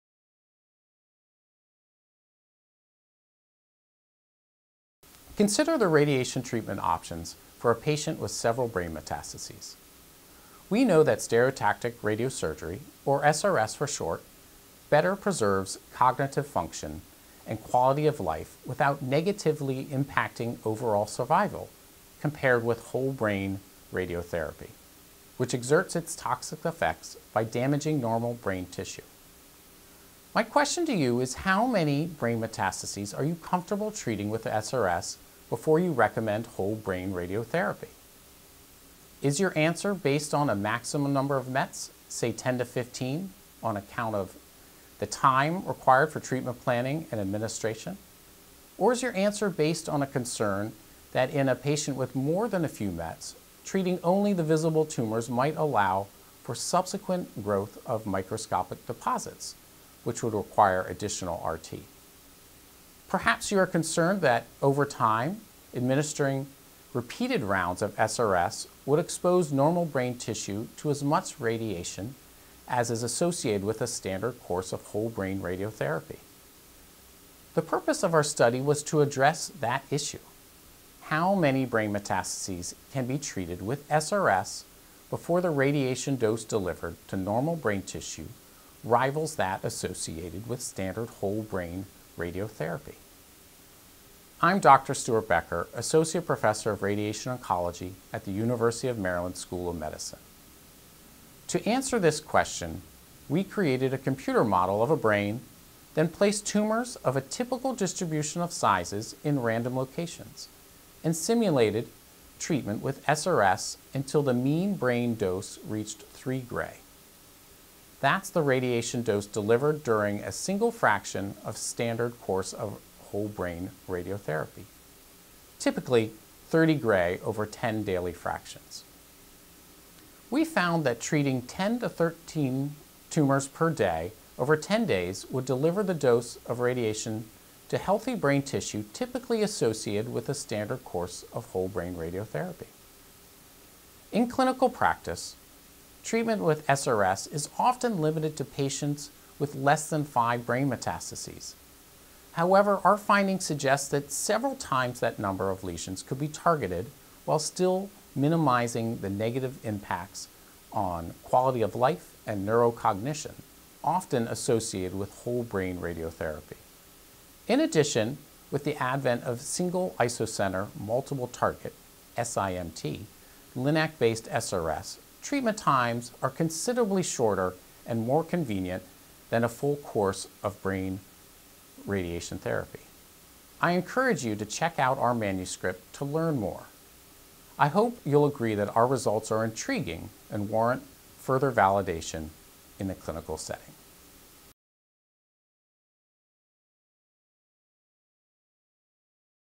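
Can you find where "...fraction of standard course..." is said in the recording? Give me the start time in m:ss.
2:00.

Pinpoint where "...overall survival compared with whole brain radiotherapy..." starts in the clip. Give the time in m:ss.
0:20.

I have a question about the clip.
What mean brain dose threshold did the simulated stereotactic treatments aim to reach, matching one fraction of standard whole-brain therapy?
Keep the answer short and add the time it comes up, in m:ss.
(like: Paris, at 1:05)
3 gray, at 1:56.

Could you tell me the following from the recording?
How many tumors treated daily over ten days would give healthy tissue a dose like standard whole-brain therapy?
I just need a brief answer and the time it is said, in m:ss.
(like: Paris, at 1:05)
10 to 13, at 2:11.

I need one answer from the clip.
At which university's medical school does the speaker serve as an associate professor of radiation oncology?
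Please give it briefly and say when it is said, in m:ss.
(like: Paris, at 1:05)
University of Maryland, at 1:38.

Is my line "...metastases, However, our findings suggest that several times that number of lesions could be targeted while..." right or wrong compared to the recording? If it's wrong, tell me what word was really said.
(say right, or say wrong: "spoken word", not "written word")
right.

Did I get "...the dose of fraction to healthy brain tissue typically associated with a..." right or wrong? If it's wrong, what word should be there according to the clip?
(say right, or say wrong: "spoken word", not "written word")
wrong: "radiation", not "fraction".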